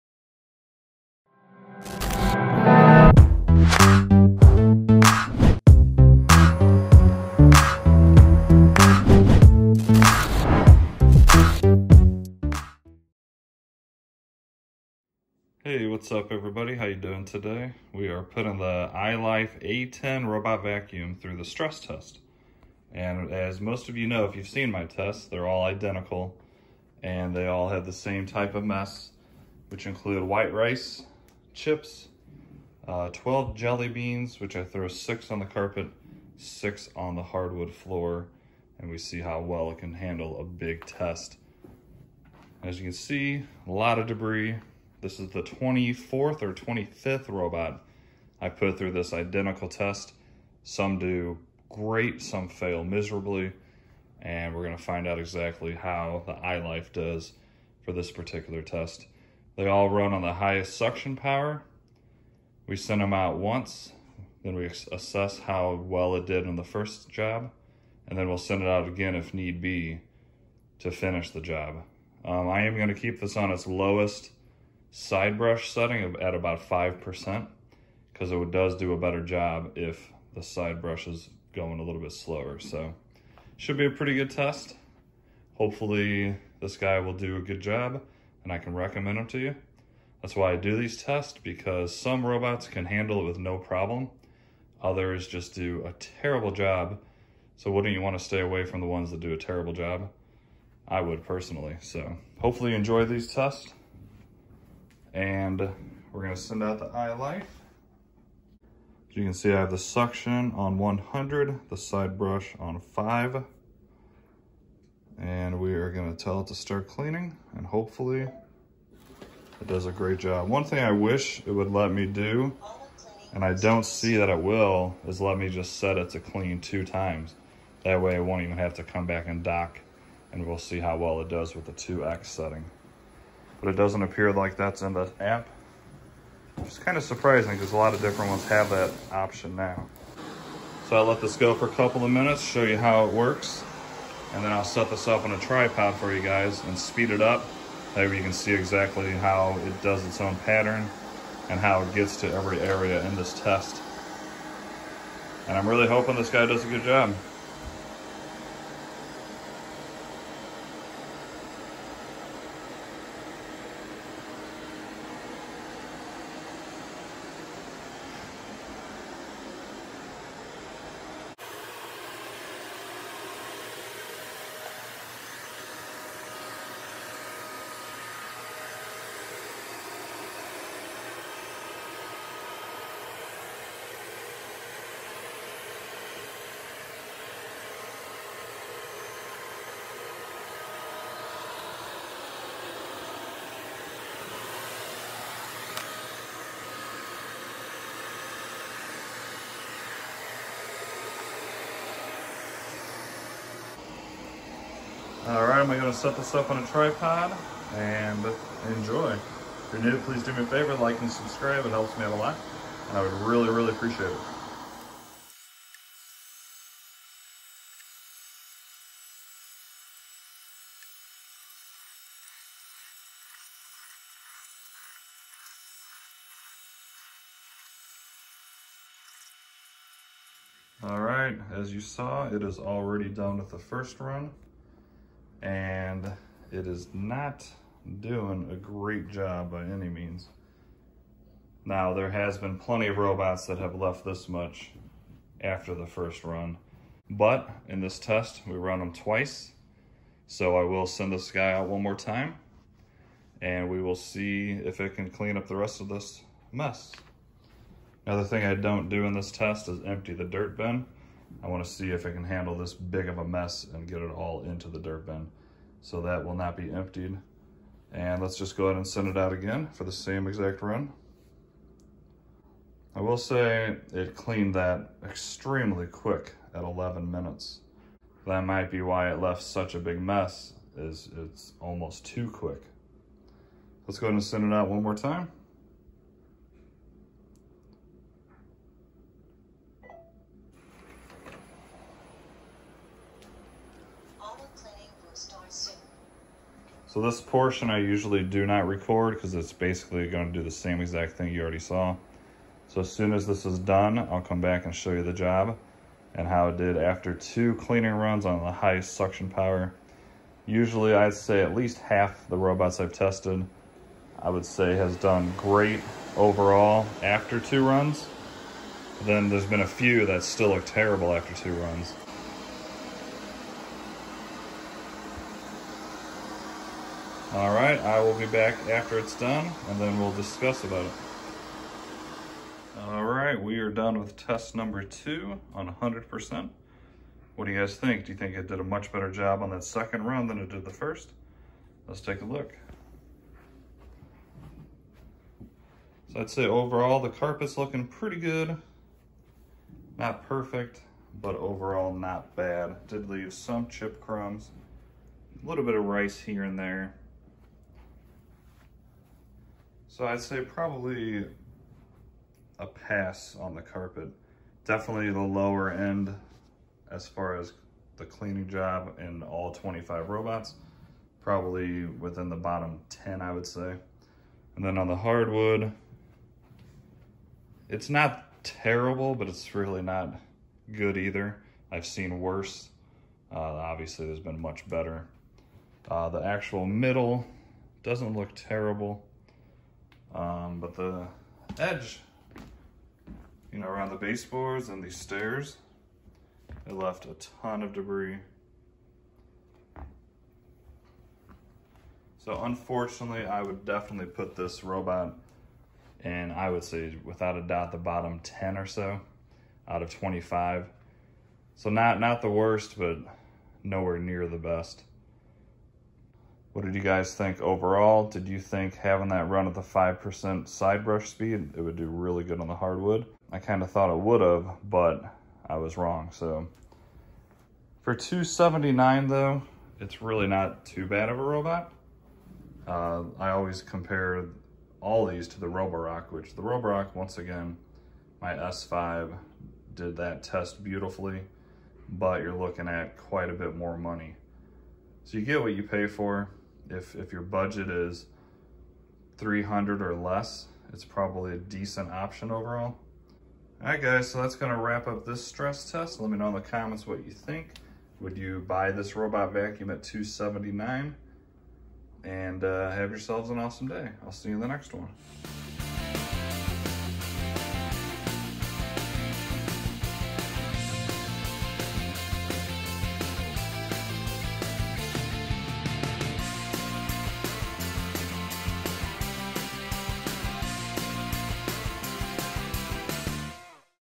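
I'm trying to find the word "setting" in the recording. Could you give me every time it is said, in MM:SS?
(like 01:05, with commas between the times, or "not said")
01:15, 02:12.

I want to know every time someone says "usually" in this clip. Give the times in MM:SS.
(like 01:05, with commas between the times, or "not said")
04:57, 05:10.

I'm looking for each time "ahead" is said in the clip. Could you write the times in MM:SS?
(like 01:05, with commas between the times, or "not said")
04:28, 04:44.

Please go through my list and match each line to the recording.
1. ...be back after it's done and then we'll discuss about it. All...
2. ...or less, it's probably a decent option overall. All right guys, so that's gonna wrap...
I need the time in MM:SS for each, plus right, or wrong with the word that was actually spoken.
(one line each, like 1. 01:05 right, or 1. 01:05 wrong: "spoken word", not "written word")
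1. 05:28 right
2. 07:29 right.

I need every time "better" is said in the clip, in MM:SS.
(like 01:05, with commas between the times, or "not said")
01:18, 05:38, 06:24.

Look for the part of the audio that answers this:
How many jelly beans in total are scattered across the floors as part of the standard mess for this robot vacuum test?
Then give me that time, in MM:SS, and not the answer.
00:33.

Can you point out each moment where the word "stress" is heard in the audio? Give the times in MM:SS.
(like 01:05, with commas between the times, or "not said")
00:21, 07:35.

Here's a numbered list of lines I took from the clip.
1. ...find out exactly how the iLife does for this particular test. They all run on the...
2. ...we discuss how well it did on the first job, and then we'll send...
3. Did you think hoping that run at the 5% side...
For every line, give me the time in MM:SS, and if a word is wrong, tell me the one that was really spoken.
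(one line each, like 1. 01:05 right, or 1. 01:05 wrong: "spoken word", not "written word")
1. 00:54 right
2. 01:04 wrong: "assess", not "discuss"
3. 06:58 wrong: "having", not "hoping".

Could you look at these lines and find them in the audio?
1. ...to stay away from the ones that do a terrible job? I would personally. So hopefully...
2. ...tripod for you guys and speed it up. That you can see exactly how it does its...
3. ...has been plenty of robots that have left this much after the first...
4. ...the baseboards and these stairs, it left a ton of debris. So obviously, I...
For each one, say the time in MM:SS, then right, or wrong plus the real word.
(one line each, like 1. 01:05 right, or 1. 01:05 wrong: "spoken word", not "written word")
1. 01:38 right
2. 02:25 right
3. 04:02 right
4. 06:33 wrong: "unfortunately", not "obviously".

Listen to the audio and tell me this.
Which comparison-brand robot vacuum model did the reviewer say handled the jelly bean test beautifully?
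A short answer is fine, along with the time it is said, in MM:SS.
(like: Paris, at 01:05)
Roborock S5, at 07:18.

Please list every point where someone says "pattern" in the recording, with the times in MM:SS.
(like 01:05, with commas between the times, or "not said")
02:30.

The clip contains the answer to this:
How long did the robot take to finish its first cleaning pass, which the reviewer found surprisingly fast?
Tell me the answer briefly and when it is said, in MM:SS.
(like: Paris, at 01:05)
11 minutes, at 04:36.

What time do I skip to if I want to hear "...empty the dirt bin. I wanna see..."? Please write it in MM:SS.
04:19.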